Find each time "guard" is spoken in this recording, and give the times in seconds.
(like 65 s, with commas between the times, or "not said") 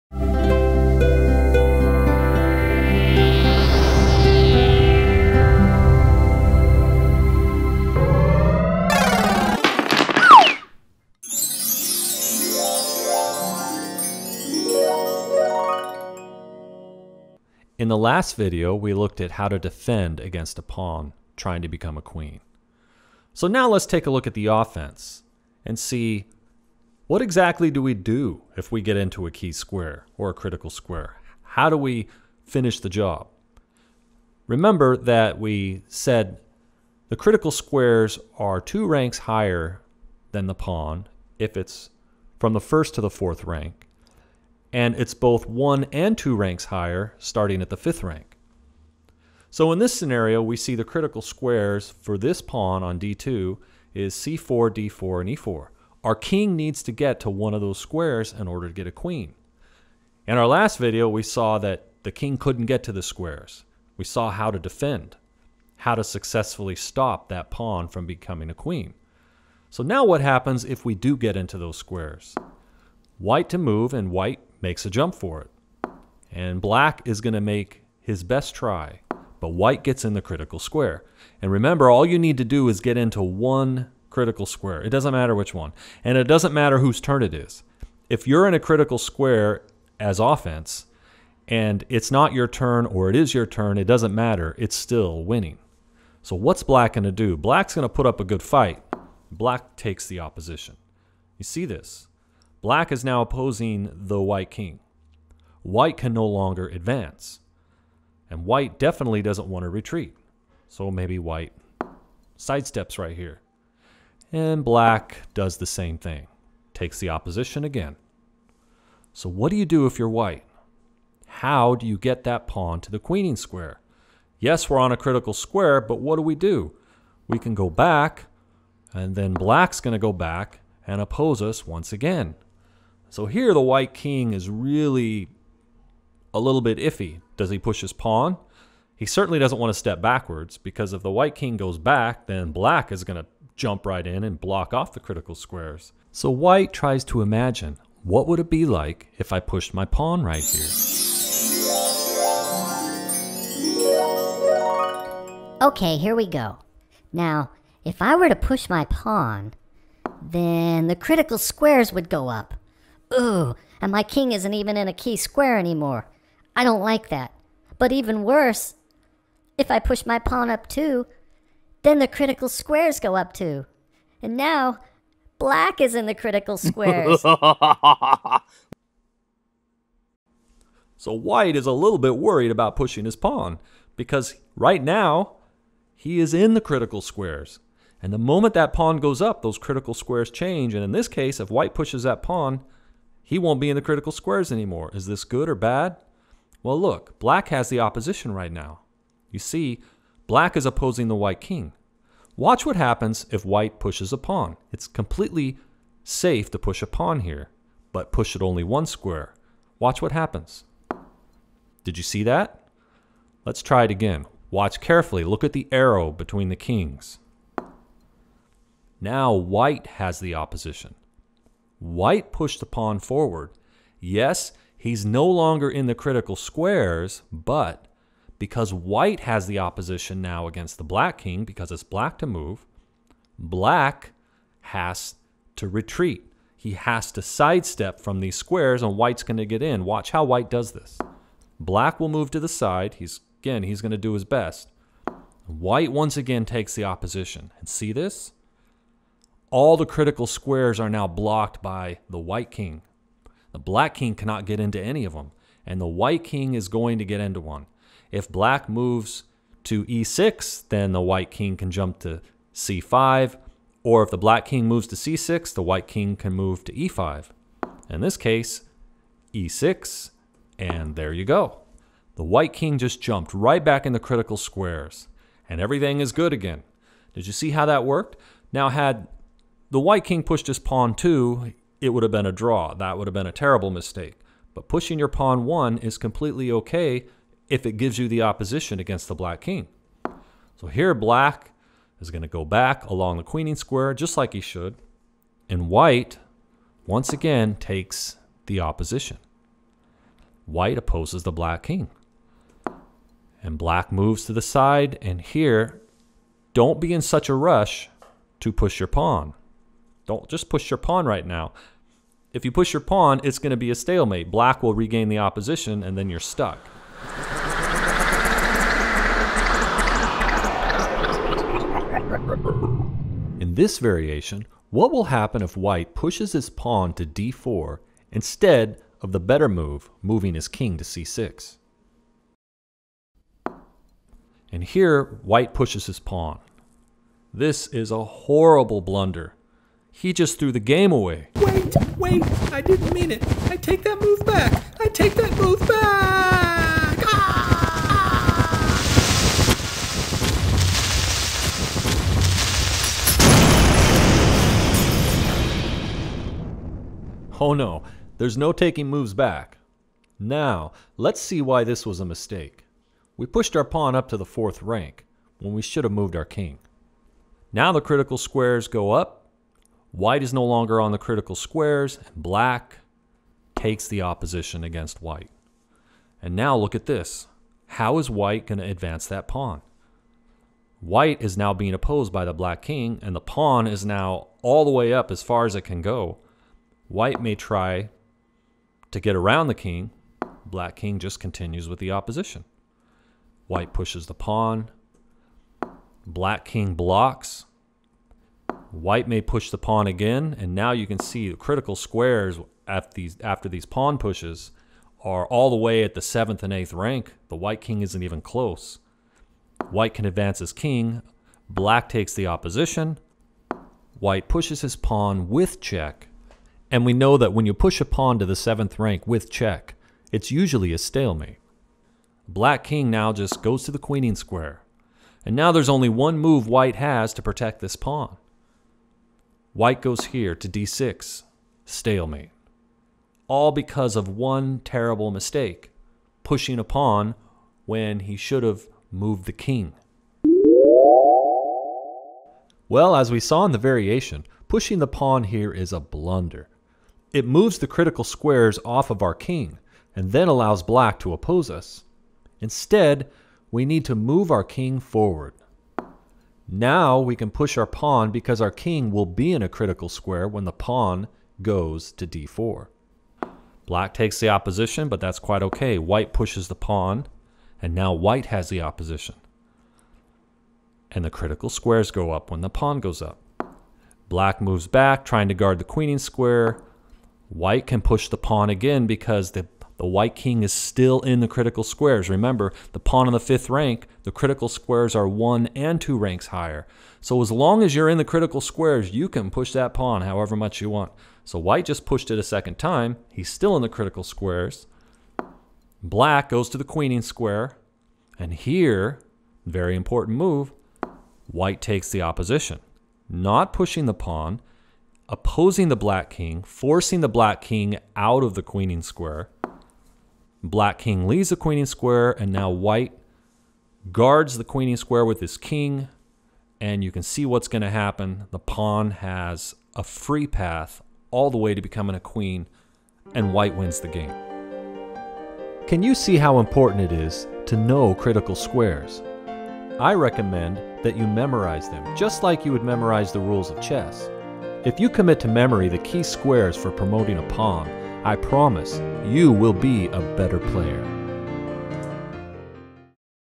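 475 s, 513 s.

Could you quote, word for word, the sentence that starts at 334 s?
And here, white pushes his pawn.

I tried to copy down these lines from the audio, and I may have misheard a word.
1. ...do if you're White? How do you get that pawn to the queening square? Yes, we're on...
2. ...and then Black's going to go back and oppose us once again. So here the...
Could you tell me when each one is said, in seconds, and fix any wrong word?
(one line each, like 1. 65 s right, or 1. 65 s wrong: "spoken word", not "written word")
1. 119 s right
2. 128 s right.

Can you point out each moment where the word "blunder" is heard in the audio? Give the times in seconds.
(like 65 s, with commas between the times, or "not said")
338 s, 445 s.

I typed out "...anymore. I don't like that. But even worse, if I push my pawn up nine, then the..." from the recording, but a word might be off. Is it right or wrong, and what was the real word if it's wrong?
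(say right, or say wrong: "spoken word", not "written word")
wrong: "two", not "nine".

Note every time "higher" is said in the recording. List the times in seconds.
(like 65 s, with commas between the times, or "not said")
39 s, 46 s, 486 s.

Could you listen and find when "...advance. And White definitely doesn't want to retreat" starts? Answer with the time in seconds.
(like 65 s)
106 s.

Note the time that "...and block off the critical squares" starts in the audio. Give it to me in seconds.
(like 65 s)
144 s.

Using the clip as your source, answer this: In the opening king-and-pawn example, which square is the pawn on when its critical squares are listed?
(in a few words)
d2.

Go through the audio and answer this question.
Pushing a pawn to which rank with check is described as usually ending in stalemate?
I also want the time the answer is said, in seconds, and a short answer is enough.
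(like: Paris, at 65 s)
7th rank, at 418 s.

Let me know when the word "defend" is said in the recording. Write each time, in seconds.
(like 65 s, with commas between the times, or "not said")
19 s, 64 s.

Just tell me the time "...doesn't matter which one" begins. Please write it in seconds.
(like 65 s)
84 s.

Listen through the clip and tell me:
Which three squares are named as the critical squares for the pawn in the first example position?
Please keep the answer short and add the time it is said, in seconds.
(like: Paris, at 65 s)
c4, d4, e4, at 54 s.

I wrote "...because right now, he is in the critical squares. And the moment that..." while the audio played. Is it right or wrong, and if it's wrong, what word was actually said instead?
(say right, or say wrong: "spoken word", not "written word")
right.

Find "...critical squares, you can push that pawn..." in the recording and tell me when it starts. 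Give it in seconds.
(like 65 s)
488 s.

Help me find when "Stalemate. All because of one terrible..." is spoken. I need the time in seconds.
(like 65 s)
431 s.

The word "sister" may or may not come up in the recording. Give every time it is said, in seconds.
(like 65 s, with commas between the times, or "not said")
not said.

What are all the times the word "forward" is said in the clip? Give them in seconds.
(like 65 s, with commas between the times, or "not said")
222 s, 454 s.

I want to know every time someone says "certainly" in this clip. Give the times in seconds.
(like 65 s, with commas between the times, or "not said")
139 s.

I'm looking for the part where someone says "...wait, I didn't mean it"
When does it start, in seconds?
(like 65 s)
341 s.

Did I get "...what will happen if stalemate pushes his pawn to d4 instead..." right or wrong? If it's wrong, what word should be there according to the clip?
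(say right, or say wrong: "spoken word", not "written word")
wrong: "white", not "stalemate".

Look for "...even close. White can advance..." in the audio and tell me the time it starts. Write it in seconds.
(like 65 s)
408 s.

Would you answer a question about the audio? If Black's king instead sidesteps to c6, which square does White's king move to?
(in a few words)
e5.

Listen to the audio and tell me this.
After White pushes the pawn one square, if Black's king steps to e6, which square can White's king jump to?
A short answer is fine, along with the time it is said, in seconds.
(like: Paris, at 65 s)
c5, at 262 s.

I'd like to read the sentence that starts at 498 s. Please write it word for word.
And here, very important move, white takes the opposition.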